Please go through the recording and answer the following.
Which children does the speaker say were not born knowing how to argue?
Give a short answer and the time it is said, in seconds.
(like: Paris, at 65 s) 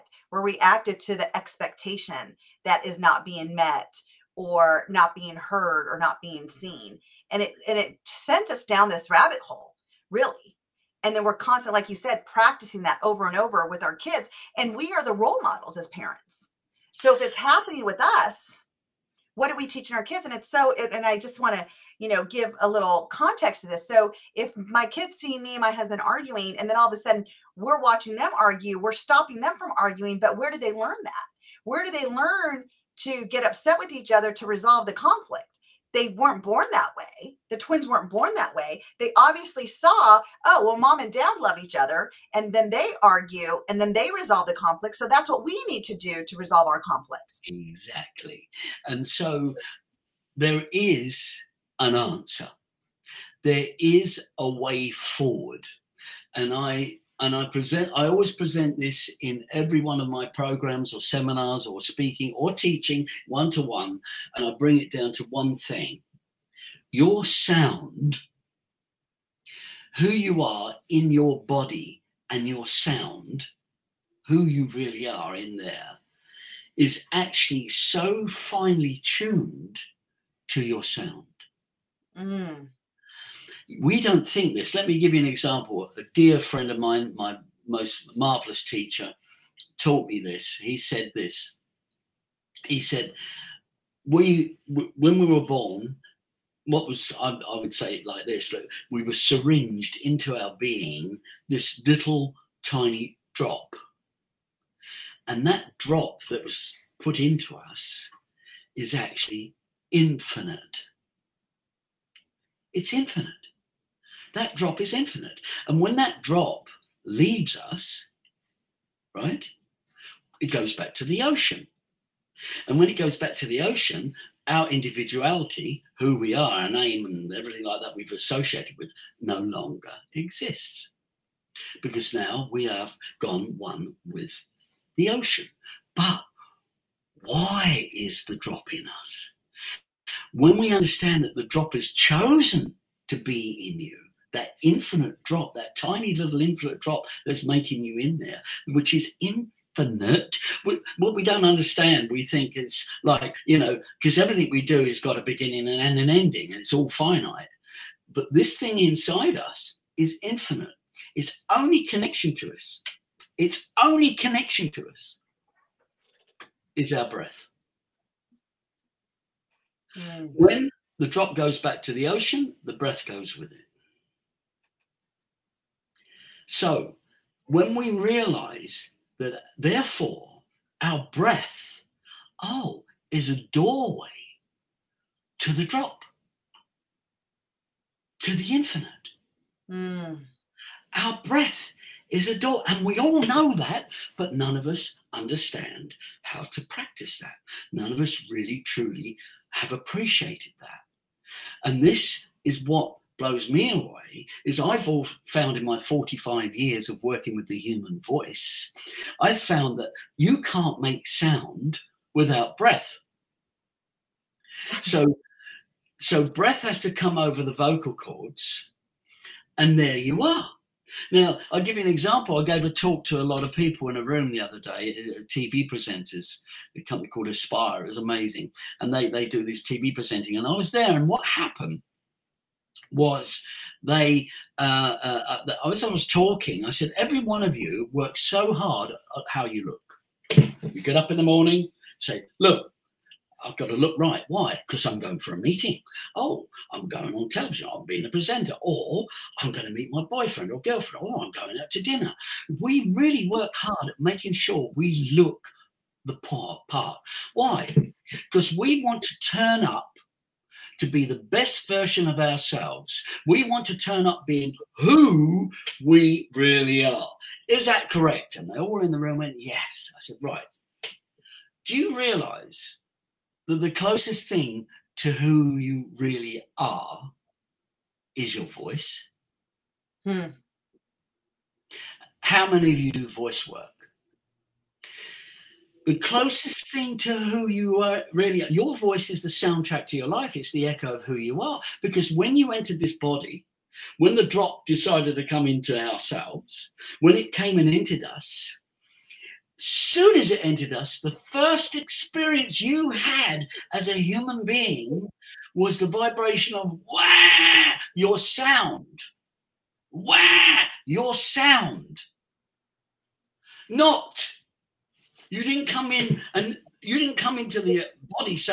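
The twins, at 37 s.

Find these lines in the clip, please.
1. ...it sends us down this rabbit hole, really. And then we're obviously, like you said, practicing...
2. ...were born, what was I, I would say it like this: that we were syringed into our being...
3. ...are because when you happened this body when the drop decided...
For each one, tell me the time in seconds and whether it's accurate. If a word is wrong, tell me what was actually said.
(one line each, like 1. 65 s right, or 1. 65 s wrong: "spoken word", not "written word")
1. 7 s wrong: "constantly", not "obviously"
2. 95 s right
3. 291 s wrong: "entered", not "happened".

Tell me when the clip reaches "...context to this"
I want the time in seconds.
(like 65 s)
23 s.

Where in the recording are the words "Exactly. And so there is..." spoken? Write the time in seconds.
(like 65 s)
47 s.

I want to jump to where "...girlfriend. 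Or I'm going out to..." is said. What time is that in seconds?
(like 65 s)
250 s.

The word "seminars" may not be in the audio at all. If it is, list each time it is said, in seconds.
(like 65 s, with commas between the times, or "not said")
60 s.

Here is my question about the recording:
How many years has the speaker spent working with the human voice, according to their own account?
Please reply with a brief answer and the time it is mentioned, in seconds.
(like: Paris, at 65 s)
45, at 205 s.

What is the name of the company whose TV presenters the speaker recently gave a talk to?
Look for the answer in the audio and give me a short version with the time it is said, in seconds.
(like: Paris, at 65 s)
Aspire, at 227 s.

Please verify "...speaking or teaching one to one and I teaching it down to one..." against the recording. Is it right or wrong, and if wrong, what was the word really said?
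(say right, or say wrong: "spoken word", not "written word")
wrong: "bring", not "teaching".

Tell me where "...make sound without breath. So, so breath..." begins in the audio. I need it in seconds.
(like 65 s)
210 s.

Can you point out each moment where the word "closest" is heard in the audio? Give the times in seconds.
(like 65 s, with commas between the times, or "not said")
273 s, 285 s.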